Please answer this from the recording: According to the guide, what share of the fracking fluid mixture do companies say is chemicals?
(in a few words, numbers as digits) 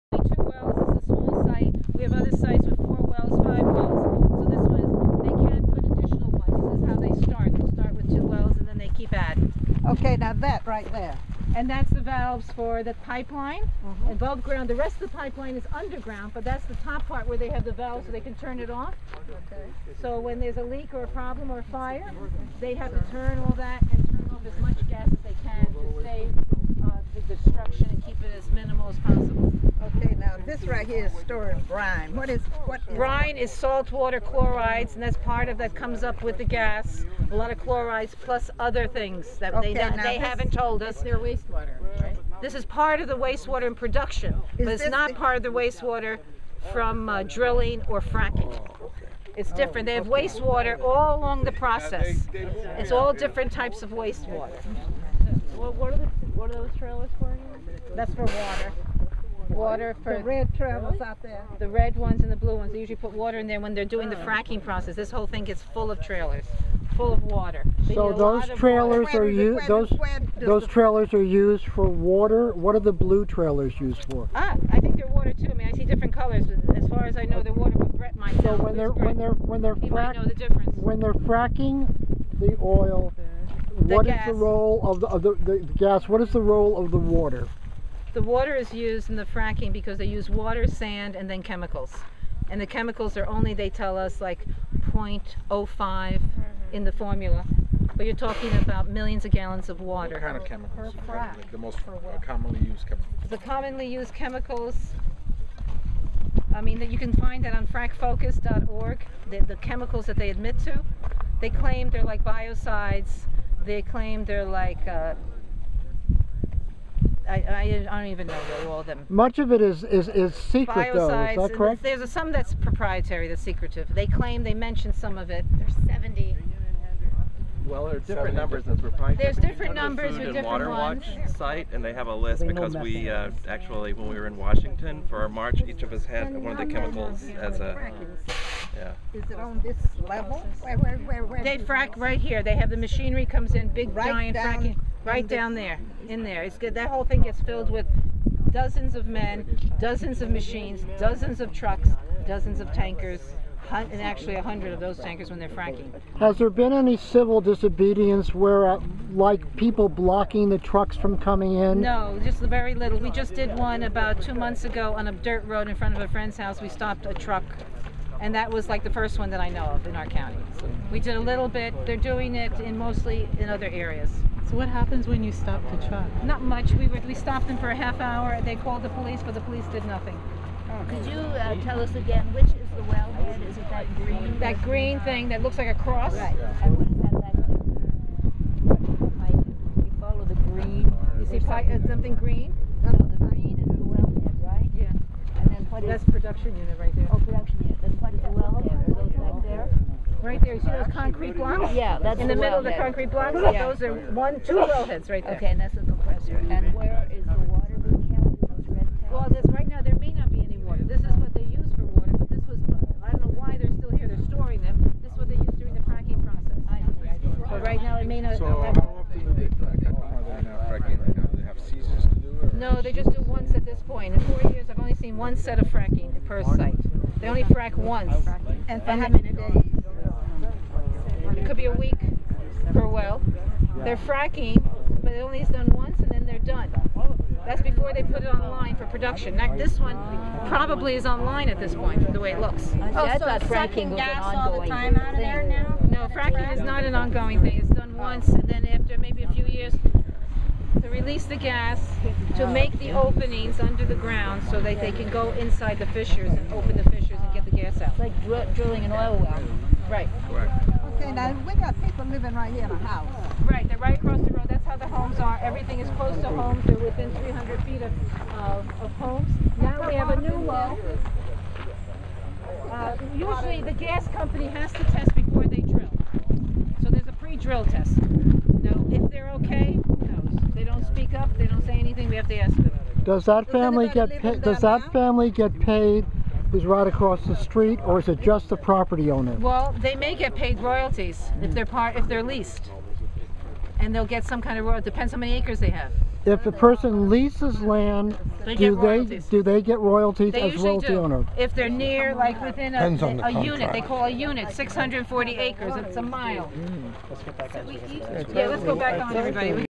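0.05.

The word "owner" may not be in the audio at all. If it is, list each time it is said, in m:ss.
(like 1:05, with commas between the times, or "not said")
4:49, 5:00.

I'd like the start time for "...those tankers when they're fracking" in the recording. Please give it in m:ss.
2:34.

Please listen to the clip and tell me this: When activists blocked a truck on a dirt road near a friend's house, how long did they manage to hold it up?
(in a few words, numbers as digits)
half hour.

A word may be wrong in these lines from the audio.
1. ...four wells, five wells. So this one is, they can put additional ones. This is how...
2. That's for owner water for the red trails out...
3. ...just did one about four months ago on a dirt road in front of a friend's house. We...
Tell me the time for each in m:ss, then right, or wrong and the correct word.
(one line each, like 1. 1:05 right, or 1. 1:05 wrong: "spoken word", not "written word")
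1. 0:02 right
2. 0:57 wrong: "water", not "owner"
3. 2:43 wrong: "two", not "four".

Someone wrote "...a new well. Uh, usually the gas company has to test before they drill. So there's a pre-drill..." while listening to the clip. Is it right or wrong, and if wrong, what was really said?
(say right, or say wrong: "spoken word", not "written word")
right.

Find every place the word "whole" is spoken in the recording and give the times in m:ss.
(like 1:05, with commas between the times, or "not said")
1:05, 2:26.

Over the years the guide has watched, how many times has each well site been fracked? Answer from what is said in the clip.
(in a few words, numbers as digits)
1.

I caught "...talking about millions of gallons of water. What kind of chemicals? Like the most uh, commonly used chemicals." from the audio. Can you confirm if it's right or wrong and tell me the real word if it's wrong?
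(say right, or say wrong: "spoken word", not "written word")
right.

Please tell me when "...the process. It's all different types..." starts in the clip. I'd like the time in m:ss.
0:51.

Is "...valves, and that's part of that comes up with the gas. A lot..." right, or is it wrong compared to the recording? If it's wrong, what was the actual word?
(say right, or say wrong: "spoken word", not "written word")
wrong: "chlorides", not "valves".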